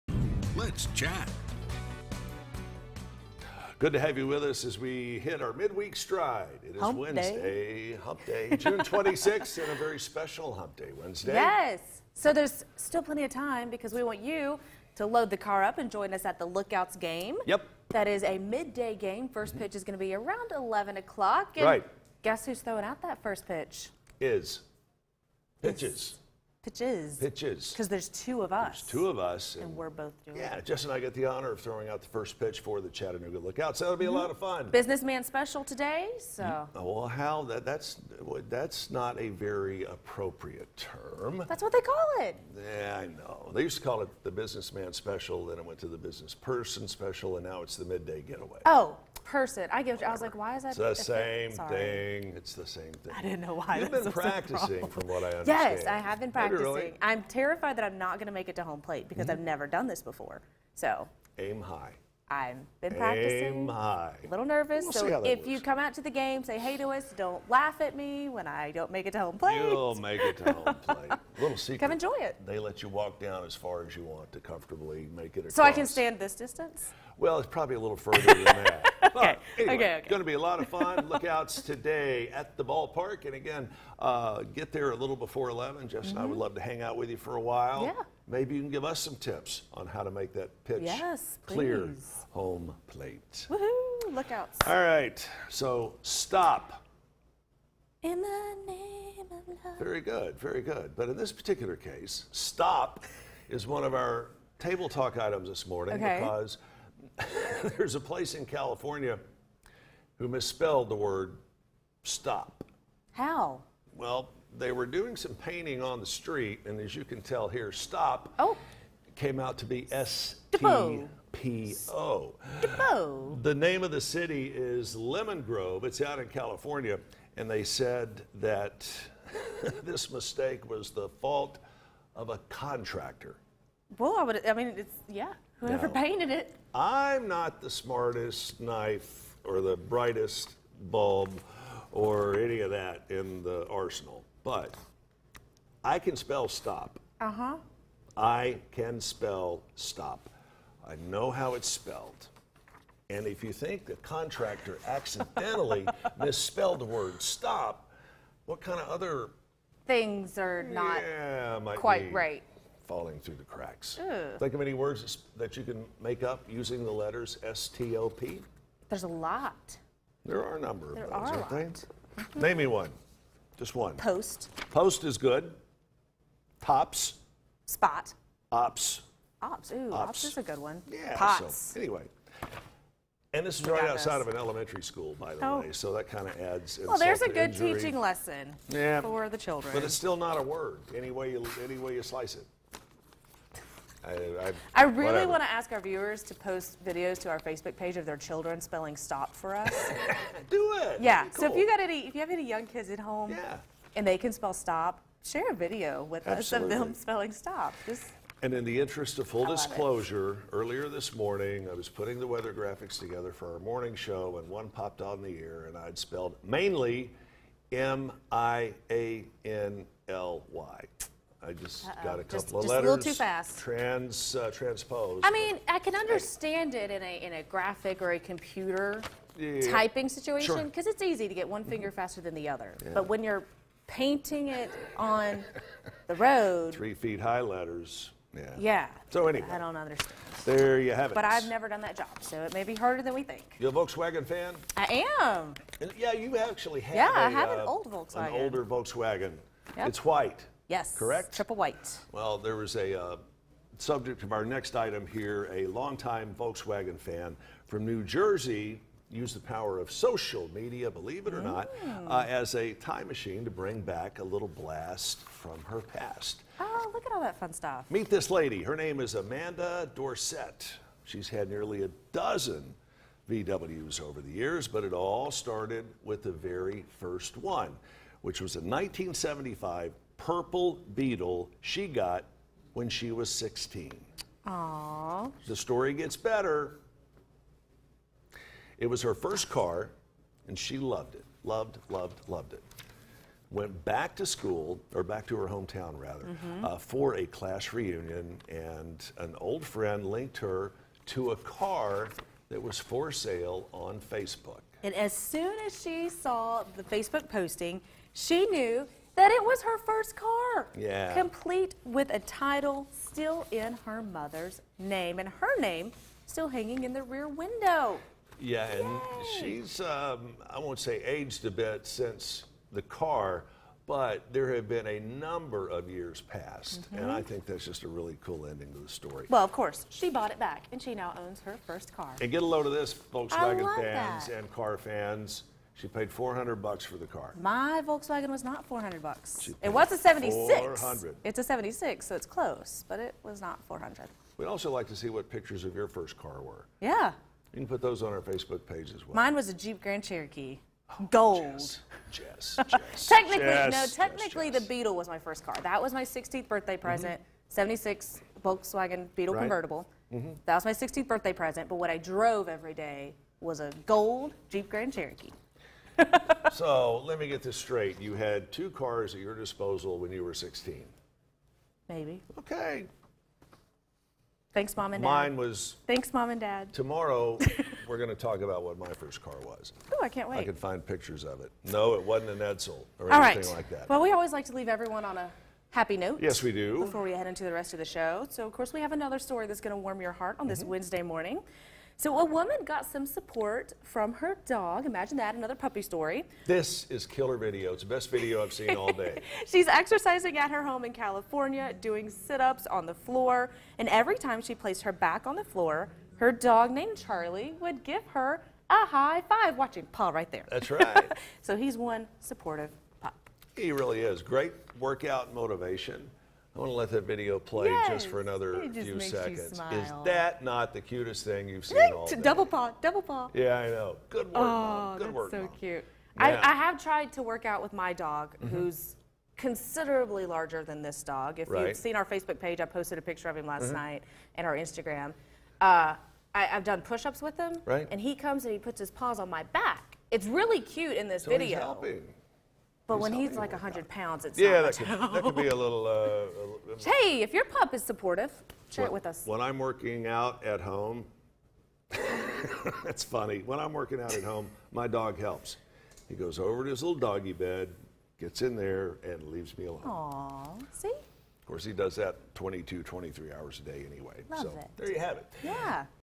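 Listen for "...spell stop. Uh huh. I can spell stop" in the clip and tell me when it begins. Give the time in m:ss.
2:26.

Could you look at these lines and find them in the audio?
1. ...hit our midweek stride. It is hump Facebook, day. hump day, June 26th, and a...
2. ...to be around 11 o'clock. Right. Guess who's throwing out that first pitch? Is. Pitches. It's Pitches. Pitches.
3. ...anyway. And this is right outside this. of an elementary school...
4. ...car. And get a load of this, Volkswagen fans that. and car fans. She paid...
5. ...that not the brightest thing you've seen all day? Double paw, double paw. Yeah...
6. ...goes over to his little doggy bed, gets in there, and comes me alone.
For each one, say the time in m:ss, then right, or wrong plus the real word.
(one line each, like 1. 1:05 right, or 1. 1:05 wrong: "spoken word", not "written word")
1. 0:05 wrong: "Wednesday", not "Facebook"
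2. 0:19 right
3. 3:01 right
4. 5:31 right
5. 7:00 wrong: "cutest", not "brightest"
6. 7:36 wrong: "leaves", not "comes".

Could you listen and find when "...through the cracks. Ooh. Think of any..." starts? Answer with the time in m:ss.
2:43.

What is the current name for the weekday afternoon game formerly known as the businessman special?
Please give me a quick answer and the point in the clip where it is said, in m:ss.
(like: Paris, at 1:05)
midday getaway, at 0:47.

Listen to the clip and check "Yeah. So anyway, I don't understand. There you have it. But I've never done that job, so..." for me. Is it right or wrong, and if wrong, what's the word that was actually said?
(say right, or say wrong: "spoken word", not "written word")
right.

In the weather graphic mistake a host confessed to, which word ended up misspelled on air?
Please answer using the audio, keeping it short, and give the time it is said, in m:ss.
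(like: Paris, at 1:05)
mainly, at 3:36.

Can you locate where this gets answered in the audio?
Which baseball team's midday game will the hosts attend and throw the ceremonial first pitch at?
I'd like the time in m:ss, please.
0:32.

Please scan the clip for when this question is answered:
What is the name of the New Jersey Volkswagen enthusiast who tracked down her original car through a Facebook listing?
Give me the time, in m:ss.
4:29.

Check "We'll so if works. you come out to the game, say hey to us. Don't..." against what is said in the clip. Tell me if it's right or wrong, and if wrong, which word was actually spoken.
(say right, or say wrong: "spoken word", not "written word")
right.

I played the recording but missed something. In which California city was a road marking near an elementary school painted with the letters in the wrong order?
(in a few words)
Lemon Grove.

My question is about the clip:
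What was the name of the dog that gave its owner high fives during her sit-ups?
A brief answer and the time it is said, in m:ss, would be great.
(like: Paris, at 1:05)
Charlie, at 6:46.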